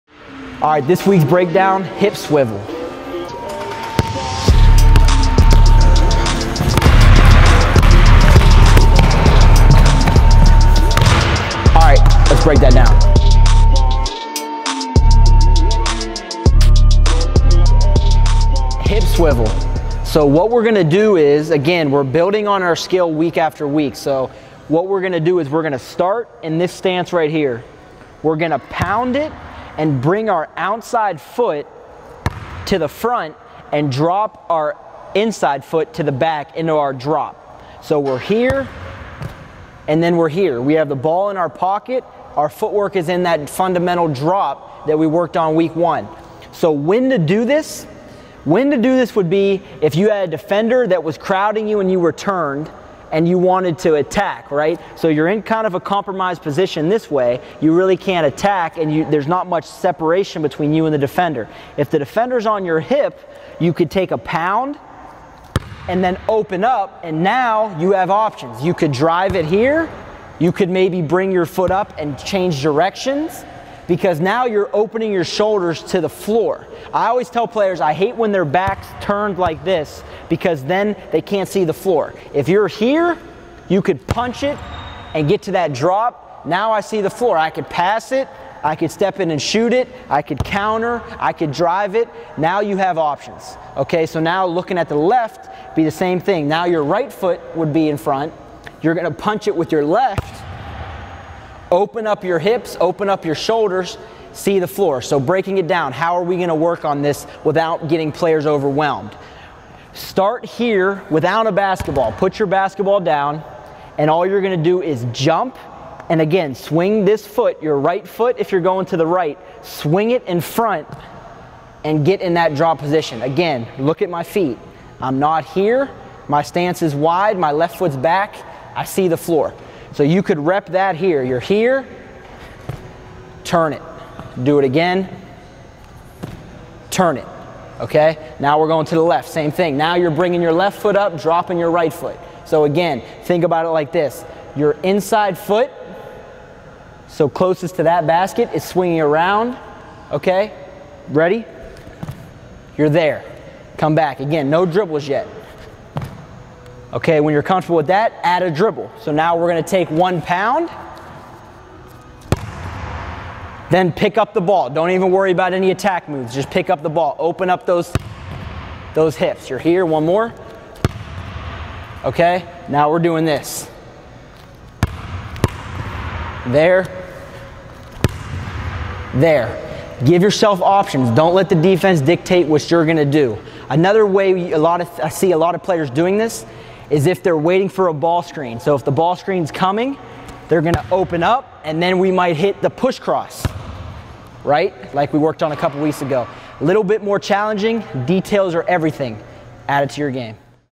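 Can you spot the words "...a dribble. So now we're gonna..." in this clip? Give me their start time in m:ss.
2:38.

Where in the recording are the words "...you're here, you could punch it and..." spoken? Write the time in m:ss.
1:22.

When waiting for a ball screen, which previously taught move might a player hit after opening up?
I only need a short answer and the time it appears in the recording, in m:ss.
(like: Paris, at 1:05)
push cross, at 3:12.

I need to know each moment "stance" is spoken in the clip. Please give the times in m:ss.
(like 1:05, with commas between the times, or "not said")
0:26, 2:06.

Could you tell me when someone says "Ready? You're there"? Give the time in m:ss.
2:31.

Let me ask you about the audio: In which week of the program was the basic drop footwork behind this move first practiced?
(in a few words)
week one.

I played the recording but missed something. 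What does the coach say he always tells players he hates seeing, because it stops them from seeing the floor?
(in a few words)
their back turned.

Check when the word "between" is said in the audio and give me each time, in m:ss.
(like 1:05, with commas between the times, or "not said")
1:00.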